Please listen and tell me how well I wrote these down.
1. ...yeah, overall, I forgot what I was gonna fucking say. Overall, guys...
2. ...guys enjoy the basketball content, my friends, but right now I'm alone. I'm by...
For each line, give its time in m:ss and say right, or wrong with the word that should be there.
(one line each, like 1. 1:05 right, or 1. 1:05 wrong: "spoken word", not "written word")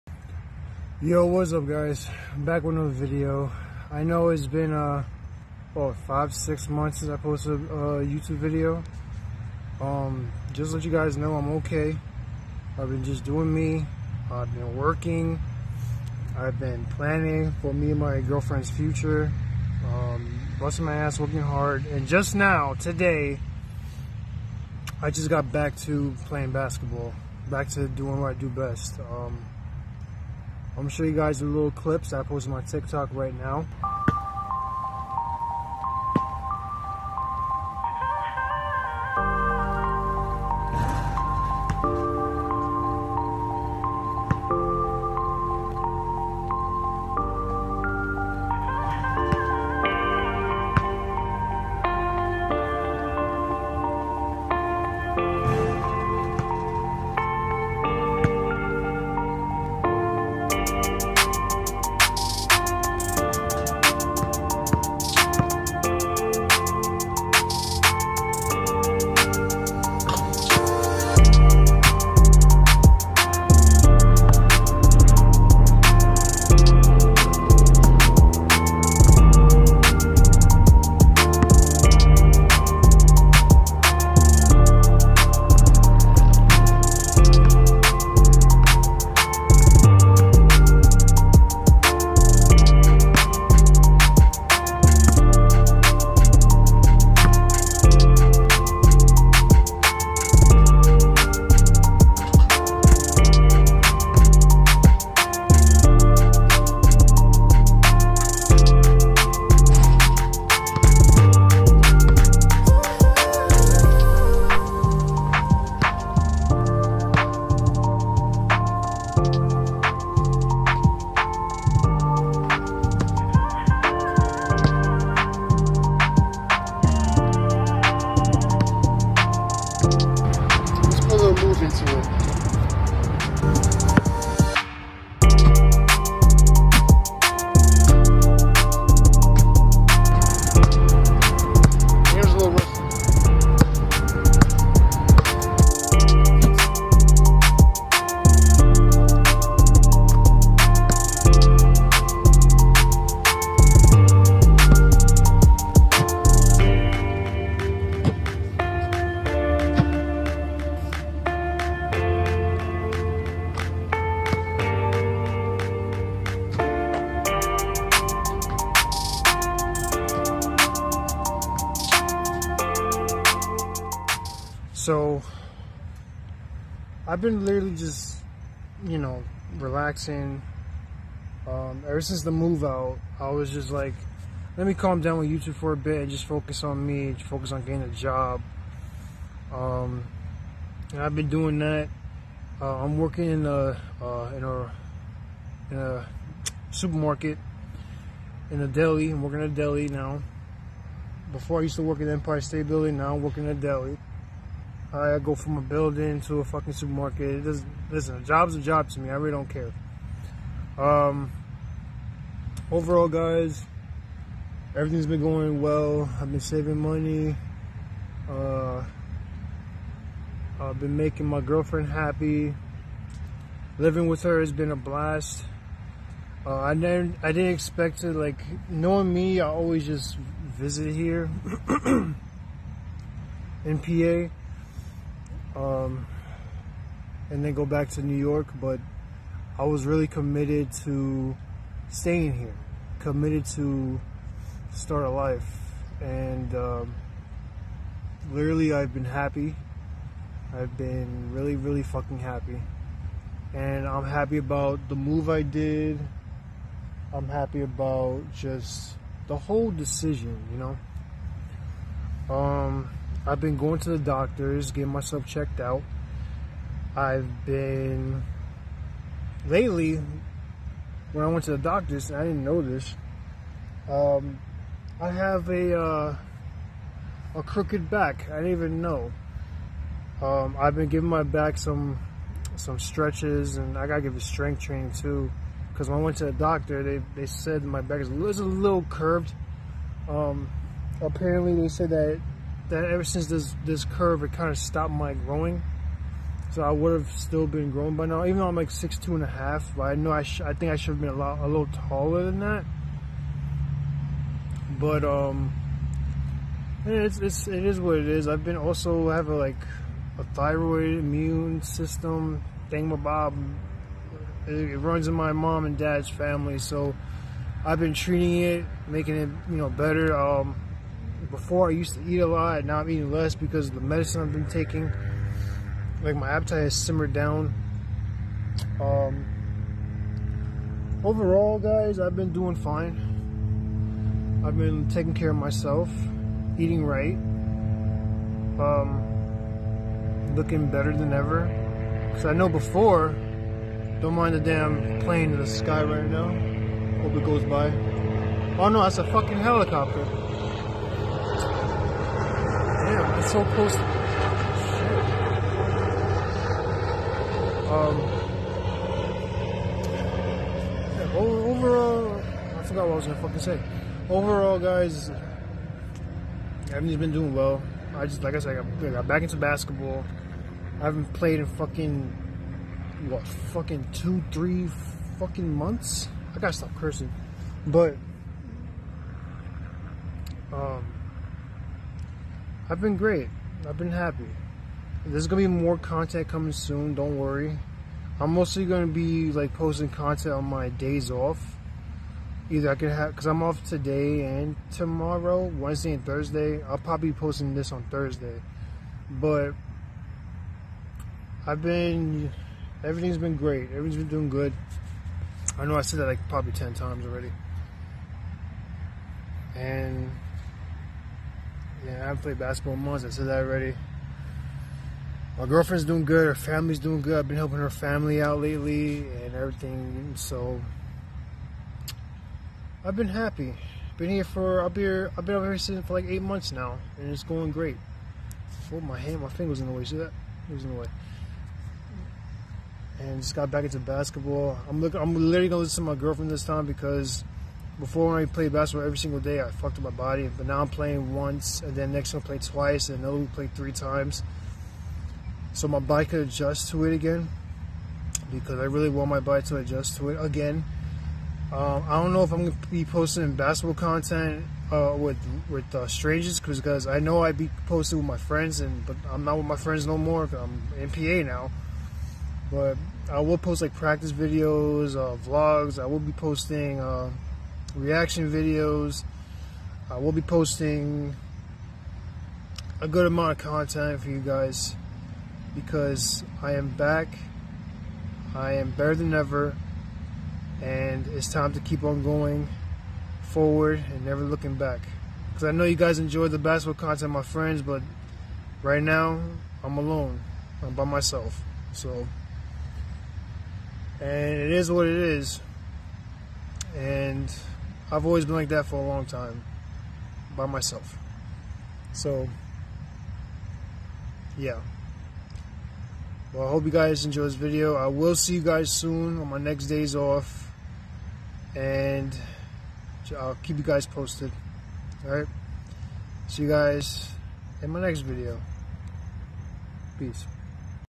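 1. 6:00 right
2. 8:05 right.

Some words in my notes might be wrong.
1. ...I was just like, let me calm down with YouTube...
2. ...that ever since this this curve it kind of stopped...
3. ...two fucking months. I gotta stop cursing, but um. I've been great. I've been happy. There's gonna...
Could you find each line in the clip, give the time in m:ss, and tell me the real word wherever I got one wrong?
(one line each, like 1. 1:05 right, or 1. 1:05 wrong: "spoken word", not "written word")
1. 3:03 right
2. 4:52 right
3. 6:14 wrong: "three", not "two".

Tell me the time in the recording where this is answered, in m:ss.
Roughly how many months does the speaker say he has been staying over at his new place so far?
7:06.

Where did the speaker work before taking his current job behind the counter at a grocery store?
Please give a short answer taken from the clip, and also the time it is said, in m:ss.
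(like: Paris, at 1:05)
Empire State Building, at 3:22.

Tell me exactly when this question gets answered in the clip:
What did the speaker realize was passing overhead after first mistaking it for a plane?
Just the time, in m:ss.
5:49.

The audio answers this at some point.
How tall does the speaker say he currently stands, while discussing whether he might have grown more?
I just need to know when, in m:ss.
4:58.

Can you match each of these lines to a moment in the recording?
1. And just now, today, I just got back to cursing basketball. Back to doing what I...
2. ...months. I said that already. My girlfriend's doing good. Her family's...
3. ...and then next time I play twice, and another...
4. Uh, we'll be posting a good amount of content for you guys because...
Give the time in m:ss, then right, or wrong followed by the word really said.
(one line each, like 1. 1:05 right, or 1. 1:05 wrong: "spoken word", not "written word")
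1. 0:21 wrong: "playing", not "cursing"
2. 6:52 right
3. 7:21 right
4. 7:49 right.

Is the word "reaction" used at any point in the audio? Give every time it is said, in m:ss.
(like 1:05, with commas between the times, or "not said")
7:47.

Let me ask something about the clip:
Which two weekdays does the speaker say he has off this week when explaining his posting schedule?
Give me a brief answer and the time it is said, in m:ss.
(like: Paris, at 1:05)
Wednesday and Thursday, at 6:35.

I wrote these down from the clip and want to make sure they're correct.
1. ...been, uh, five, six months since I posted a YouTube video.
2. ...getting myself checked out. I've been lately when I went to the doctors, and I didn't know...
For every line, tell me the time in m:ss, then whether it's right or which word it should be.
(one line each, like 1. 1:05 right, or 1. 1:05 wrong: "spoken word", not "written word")
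1. 0:04 right
2. 4:24 right.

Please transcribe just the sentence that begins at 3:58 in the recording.
But I was really committed to staying here, committed to start a life.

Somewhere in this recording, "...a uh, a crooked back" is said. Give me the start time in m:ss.
4:35.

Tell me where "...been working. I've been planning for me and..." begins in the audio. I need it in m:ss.
0:14.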